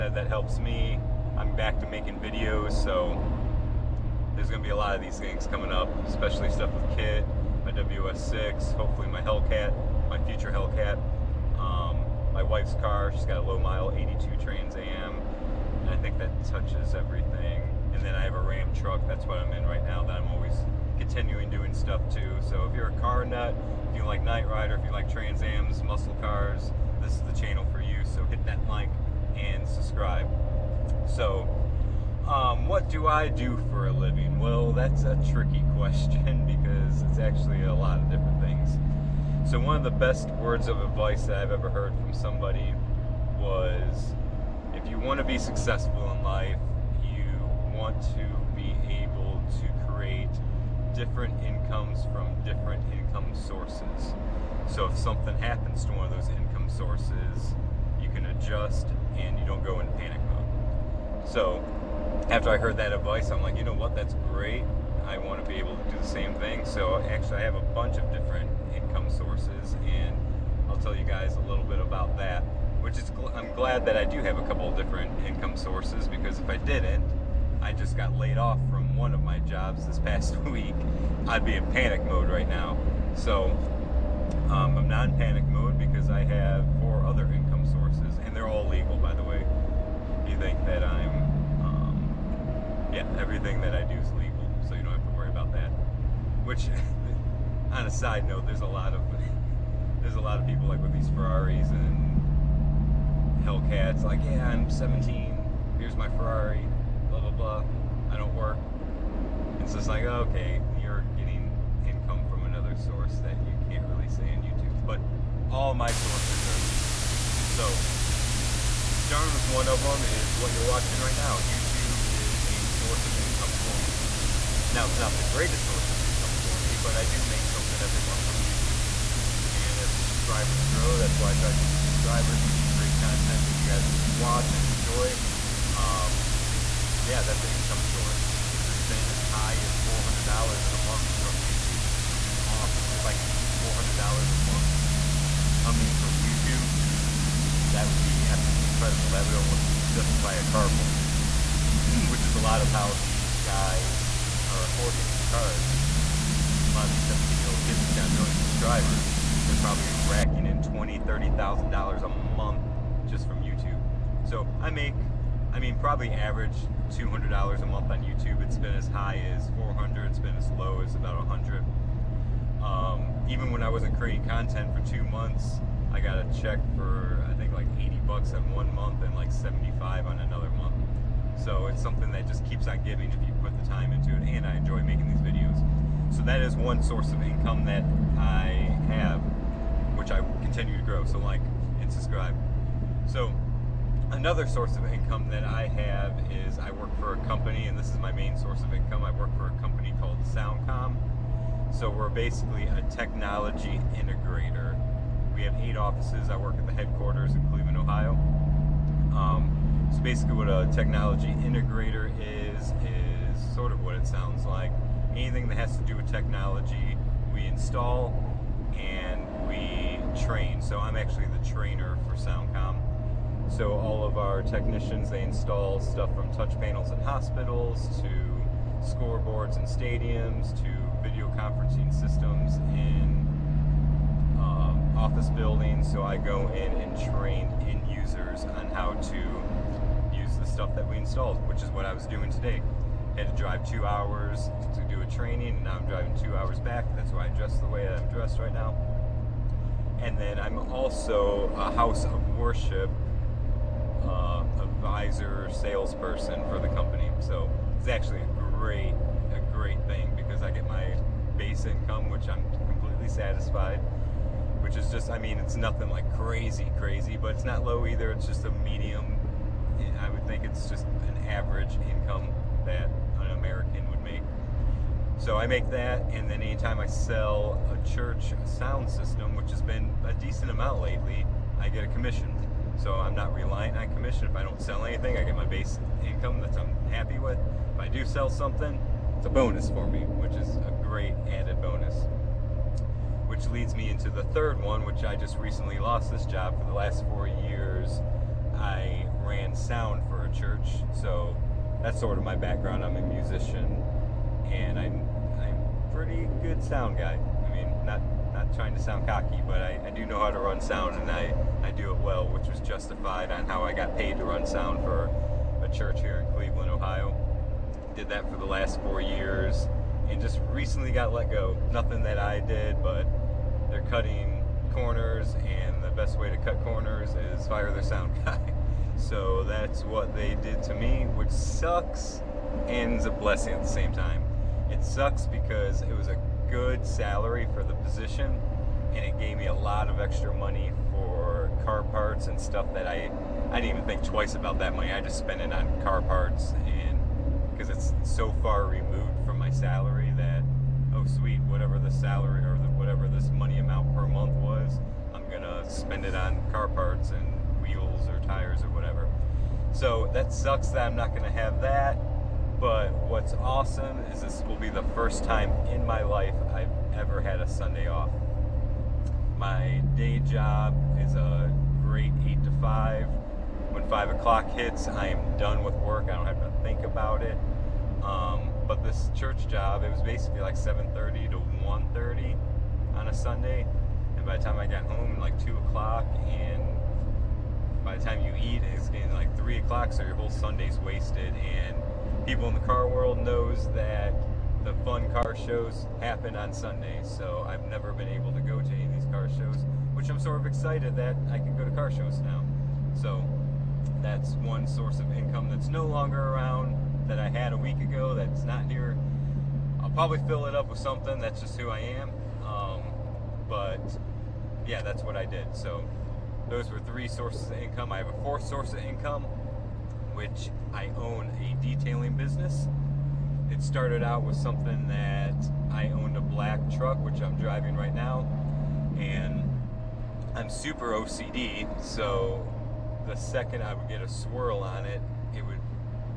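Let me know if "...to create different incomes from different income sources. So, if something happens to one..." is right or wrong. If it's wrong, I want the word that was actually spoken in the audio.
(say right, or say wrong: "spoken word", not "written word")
right.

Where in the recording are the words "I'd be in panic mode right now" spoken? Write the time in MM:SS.
01:21.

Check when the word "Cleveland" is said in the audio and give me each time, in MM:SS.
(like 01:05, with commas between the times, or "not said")
03:27, 05:16.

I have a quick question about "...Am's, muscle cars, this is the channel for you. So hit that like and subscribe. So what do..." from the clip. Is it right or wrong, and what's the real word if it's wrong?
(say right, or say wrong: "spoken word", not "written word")
right.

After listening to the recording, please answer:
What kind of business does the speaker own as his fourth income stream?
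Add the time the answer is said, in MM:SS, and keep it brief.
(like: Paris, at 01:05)
Detailing business, at 07:01.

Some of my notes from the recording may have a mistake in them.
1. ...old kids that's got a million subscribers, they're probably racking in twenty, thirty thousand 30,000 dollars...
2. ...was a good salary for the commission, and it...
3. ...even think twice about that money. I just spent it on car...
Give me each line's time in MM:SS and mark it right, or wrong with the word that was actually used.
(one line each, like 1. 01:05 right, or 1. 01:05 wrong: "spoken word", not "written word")
1. 02:37 right
2. 05:35 wrong: "position", not "commission"
3. 05:43 right.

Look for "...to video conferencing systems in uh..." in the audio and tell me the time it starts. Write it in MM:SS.
03:50.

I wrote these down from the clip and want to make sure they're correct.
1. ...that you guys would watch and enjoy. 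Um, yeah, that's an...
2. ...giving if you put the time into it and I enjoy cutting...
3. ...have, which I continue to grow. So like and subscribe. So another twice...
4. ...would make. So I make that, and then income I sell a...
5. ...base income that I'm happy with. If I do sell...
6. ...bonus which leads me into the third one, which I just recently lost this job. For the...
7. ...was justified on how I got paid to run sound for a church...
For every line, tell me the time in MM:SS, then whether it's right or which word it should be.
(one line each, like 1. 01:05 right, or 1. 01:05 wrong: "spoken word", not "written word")
1. 02:13 right
2. 03:02 wrong: "making", not "cutting"
3. 03:08 wrong: "source", not "twice"
4. 04:33 wrong: "anytime", not "income"
5. 04:45 right
6. 04:51 right
7. 05:12 right.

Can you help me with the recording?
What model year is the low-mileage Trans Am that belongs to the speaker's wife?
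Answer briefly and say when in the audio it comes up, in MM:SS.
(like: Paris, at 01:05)
1982, at 00:13.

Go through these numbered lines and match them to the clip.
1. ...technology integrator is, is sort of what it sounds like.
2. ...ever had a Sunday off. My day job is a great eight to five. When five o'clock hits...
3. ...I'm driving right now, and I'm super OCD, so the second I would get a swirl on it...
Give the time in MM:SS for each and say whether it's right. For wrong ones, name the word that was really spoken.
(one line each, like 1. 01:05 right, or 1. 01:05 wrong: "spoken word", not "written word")
1. 03:30 right
2. 06:06 right
3. 07:07 right.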